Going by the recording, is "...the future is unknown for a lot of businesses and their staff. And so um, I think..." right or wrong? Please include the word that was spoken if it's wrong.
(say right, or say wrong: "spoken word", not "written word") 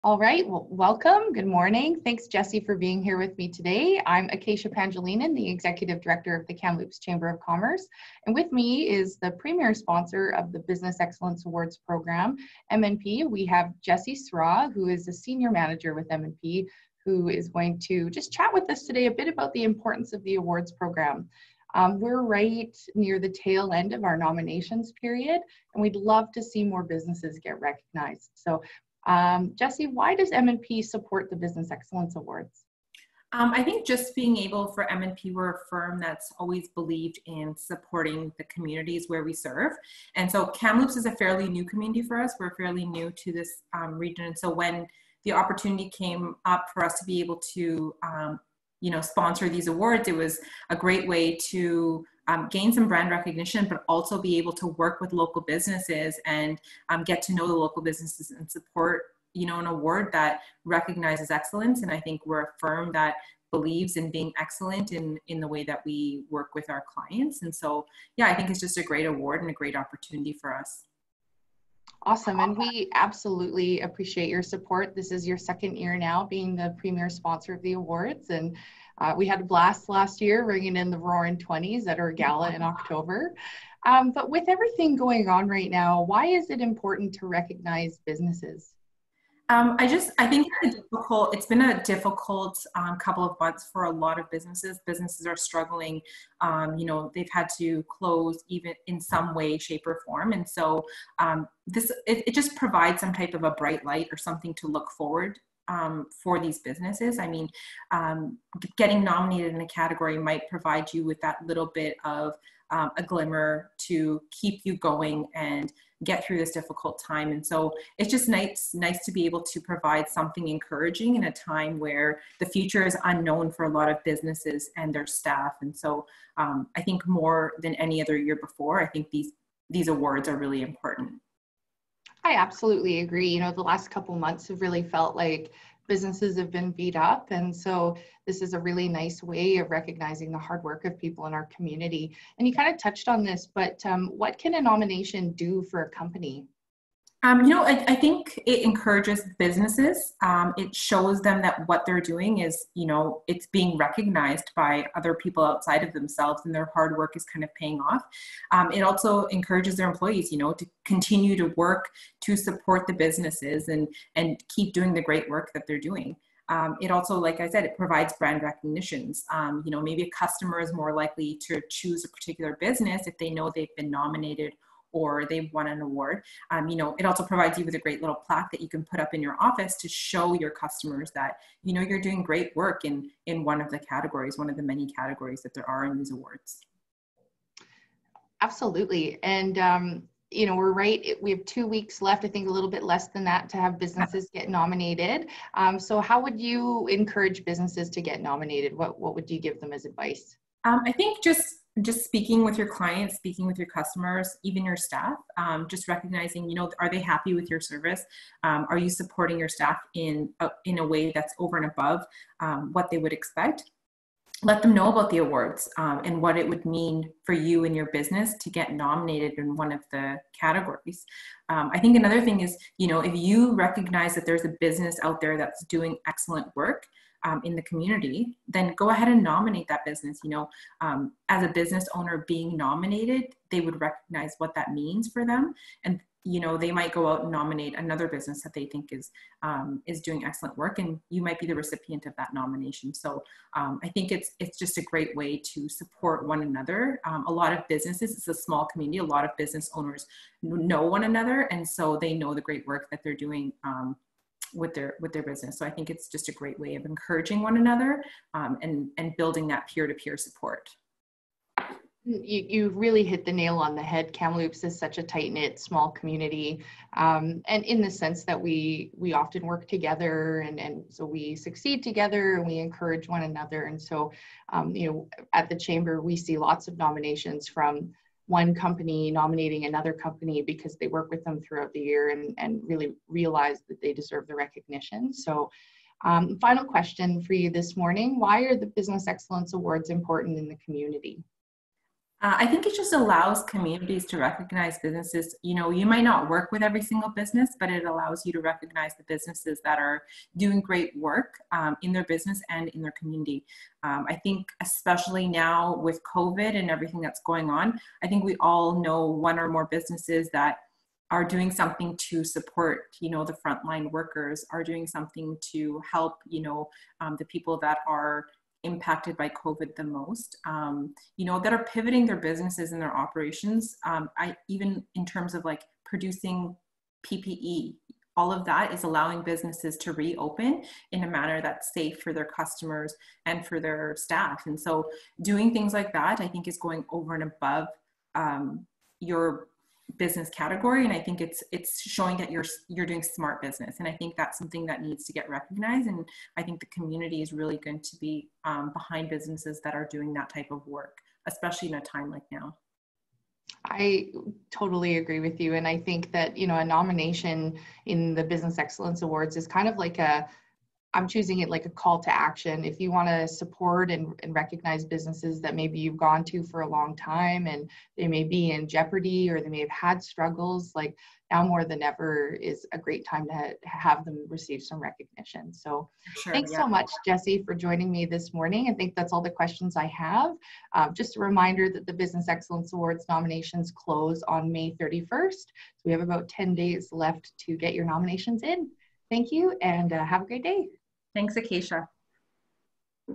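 right.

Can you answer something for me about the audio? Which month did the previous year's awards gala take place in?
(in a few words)
October.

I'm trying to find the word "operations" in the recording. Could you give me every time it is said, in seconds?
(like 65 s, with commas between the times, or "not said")
322 s.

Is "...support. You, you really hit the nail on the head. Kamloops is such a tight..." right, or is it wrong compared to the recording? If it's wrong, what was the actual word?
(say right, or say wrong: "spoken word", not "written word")
right.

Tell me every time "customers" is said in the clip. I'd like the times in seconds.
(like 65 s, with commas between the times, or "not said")
170 s, 180 s, 203 s, 332 s.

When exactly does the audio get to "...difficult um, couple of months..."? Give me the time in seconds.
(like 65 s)
91 s.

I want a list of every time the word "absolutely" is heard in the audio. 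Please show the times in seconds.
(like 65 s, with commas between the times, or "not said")
72 s, 132 s, 188 s.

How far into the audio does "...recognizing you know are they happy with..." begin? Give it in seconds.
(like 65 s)
205 s.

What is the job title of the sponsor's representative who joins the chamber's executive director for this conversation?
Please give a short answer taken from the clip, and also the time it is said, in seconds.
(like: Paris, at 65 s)
Senior Manager, at 15 s.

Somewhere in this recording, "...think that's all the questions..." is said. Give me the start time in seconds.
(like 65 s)
378 s.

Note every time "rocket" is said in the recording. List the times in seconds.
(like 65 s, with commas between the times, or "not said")
not said.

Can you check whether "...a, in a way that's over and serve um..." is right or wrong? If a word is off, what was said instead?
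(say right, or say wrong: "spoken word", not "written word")
wrong: "above", not "serve".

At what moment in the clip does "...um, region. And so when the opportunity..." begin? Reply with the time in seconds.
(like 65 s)
43 s.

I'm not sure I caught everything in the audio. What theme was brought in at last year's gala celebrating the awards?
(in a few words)
Roaring 20s.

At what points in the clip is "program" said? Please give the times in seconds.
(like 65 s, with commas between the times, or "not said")
11 s, 20 s.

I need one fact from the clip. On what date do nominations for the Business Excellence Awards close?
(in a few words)
May 31st.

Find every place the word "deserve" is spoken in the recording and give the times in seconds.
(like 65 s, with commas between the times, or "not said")
283 s.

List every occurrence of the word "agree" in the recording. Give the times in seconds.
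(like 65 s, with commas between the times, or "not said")
132 s, 354 s.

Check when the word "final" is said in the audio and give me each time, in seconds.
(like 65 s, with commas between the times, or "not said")
286 s.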